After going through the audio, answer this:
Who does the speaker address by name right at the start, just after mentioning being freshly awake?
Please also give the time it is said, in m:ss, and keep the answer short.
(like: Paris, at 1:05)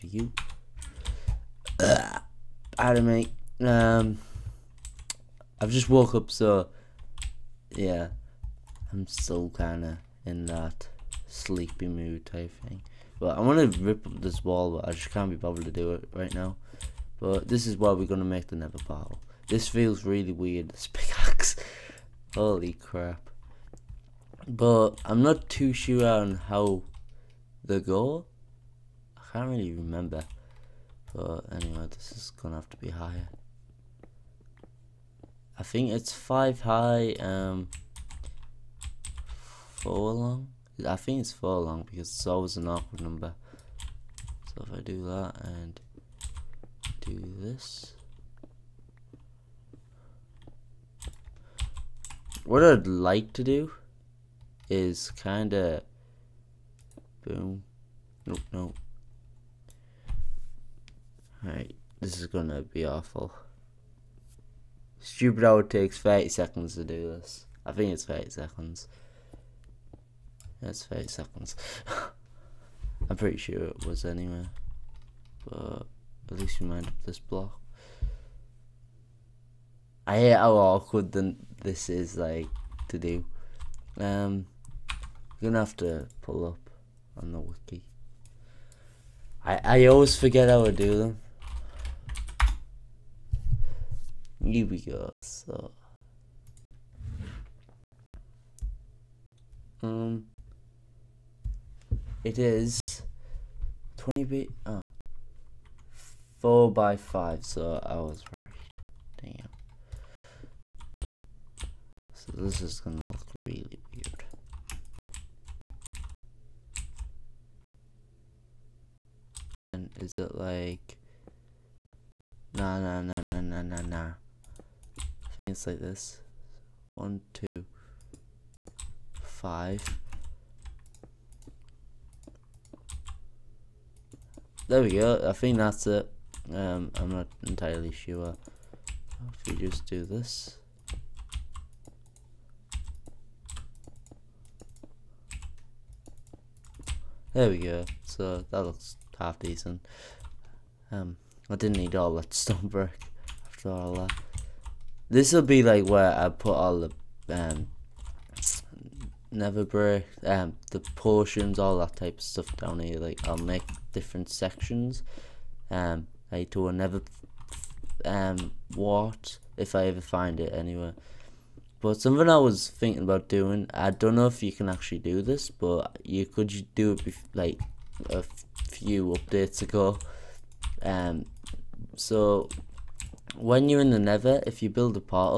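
Adam, at 0:02.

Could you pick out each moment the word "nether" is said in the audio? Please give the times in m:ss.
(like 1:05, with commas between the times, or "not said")
0:18, 2:39, 3:03.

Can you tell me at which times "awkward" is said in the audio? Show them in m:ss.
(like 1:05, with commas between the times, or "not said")
0:42, 1:20.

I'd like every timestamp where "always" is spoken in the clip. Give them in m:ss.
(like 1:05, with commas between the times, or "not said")
0:42, 1:29.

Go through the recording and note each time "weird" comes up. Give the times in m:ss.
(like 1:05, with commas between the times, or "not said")
0:20, 1:53.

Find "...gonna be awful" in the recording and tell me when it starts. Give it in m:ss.
1:02.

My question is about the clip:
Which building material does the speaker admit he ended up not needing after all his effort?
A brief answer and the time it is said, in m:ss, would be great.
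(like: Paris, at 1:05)
Stone brick, at 2:32.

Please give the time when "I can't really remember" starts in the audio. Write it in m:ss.
0:29.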